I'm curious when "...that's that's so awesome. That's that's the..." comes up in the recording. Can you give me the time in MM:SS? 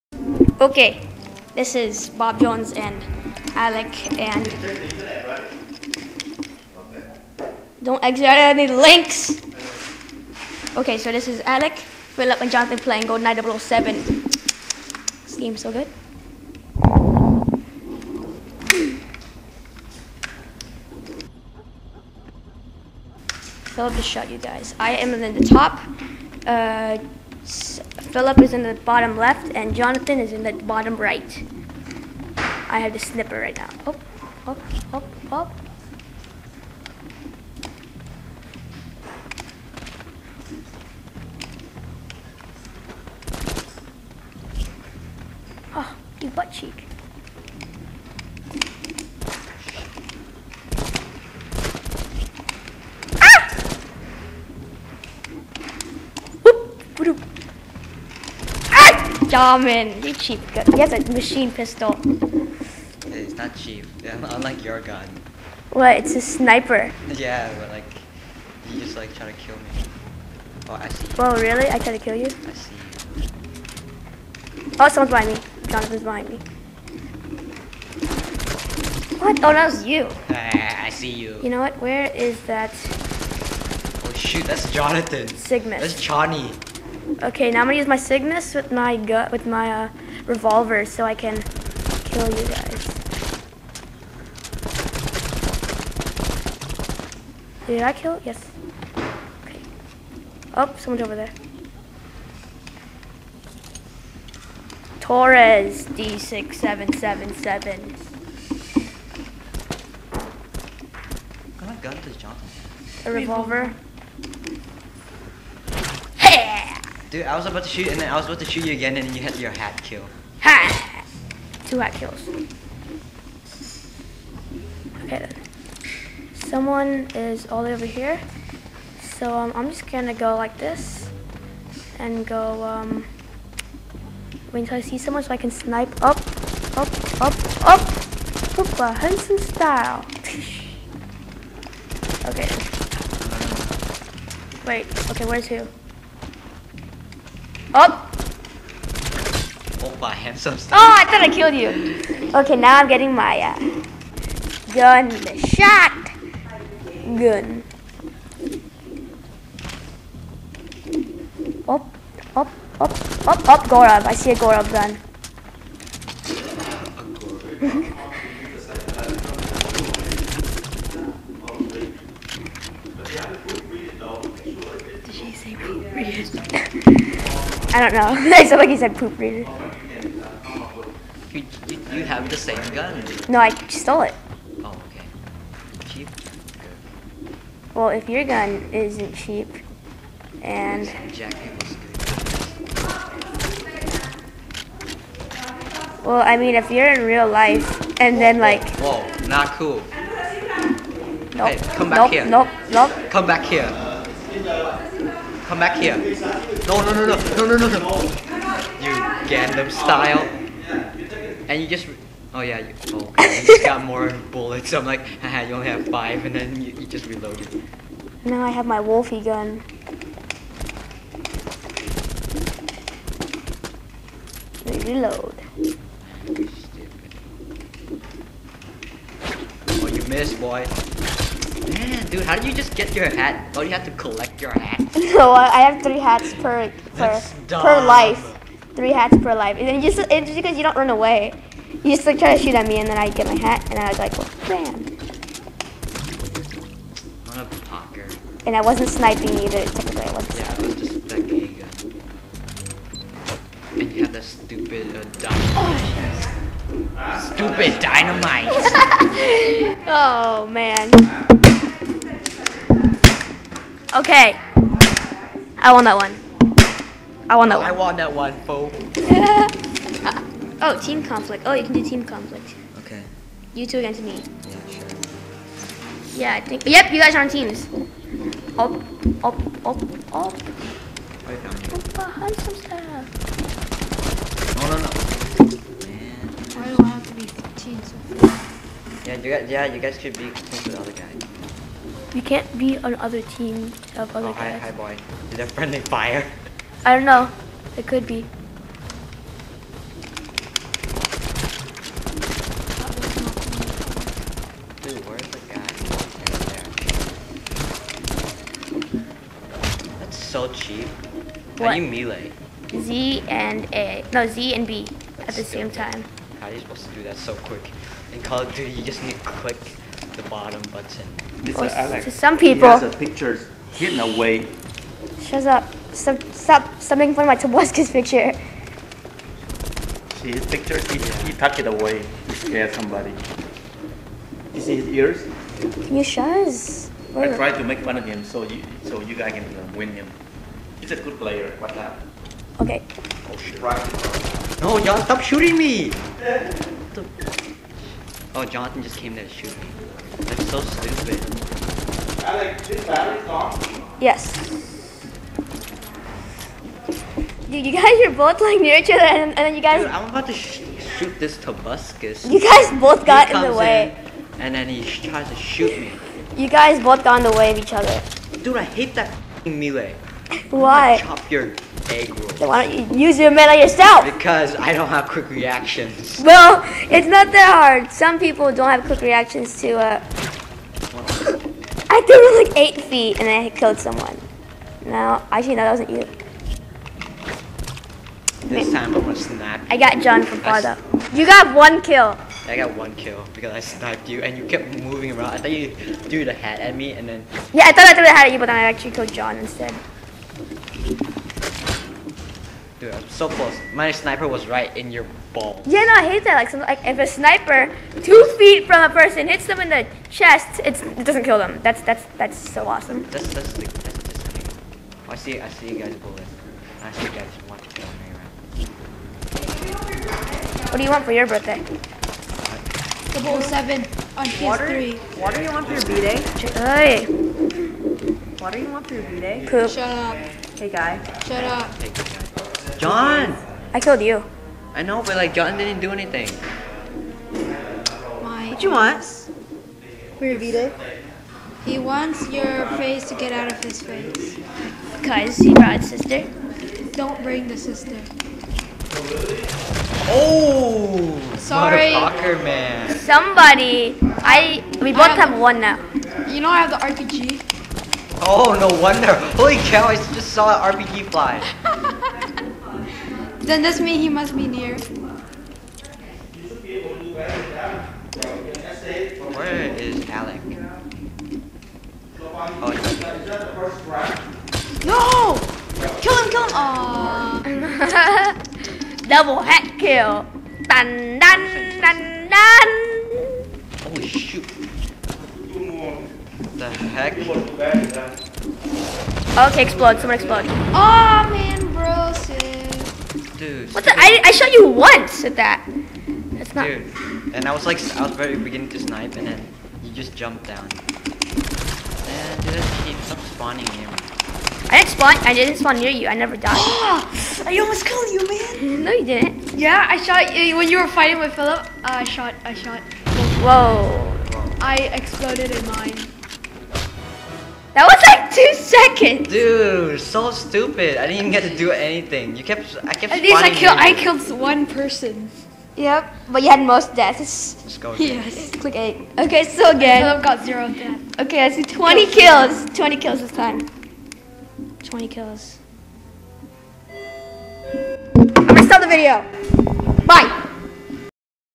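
06:51.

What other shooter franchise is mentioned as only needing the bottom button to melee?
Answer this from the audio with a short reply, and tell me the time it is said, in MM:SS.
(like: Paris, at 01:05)
Call of Duty, at 05:18.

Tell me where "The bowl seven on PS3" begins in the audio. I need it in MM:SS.
07:01.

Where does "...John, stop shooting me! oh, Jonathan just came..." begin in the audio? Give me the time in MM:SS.
05:44.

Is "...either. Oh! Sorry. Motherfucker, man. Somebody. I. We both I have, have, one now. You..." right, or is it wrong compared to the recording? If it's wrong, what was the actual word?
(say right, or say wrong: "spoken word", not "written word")
wrong: "sister", not "either".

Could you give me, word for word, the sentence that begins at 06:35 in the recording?
I thought you threw the hat at me and then.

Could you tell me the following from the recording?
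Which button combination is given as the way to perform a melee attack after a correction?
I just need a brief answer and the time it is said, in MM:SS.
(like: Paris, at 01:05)
Z and B, at 05:14.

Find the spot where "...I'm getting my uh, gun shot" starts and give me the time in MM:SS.
02:32.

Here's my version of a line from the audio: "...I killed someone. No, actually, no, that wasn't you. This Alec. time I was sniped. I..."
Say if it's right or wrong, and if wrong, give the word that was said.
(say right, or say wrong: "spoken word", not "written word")
wrong: "Wait", not "Alec".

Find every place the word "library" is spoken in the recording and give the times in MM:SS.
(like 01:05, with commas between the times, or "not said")
not said.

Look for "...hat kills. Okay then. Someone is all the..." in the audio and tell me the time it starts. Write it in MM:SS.
02:01.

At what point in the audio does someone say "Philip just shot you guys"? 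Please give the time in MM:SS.
00:23.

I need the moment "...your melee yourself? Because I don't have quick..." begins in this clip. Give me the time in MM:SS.
06:13.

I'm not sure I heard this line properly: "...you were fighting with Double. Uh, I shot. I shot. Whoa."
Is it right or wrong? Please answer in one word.
wrong.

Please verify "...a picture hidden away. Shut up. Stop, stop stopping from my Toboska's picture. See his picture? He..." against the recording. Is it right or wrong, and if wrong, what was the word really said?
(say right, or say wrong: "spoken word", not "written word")
right.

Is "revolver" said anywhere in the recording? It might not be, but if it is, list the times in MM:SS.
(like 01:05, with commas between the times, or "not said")
01:30, 01:53.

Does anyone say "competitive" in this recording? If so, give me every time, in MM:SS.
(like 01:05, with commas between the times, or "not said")
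not said.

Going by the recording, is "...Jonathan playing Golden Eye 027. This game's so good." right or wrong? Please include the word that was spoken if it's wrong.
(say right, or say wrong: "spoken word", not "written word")
wrong: "007", not "027".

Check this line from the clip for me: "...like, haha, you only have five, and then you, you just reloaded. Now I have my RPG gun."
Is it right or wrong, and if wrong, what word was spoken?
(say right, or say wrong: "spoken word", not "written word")
wrong: "Wolfie", not "RPG".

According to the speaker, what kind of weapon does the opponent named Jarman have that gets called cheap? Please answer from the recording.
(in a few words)
machine pistol.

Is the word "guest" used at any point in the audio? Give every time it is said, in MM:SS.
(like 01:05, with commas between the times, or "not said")
not said.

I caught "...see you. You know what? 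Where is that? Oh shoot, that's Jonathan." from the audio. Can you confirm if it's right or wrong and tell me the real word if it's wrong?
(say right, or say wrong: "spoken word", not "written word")
right.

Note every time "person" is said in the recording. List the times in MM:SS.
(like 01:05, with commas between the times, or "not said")
06:48, 08:44.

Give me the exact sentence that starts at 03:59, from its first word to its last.
And then just it's just because you don't run away.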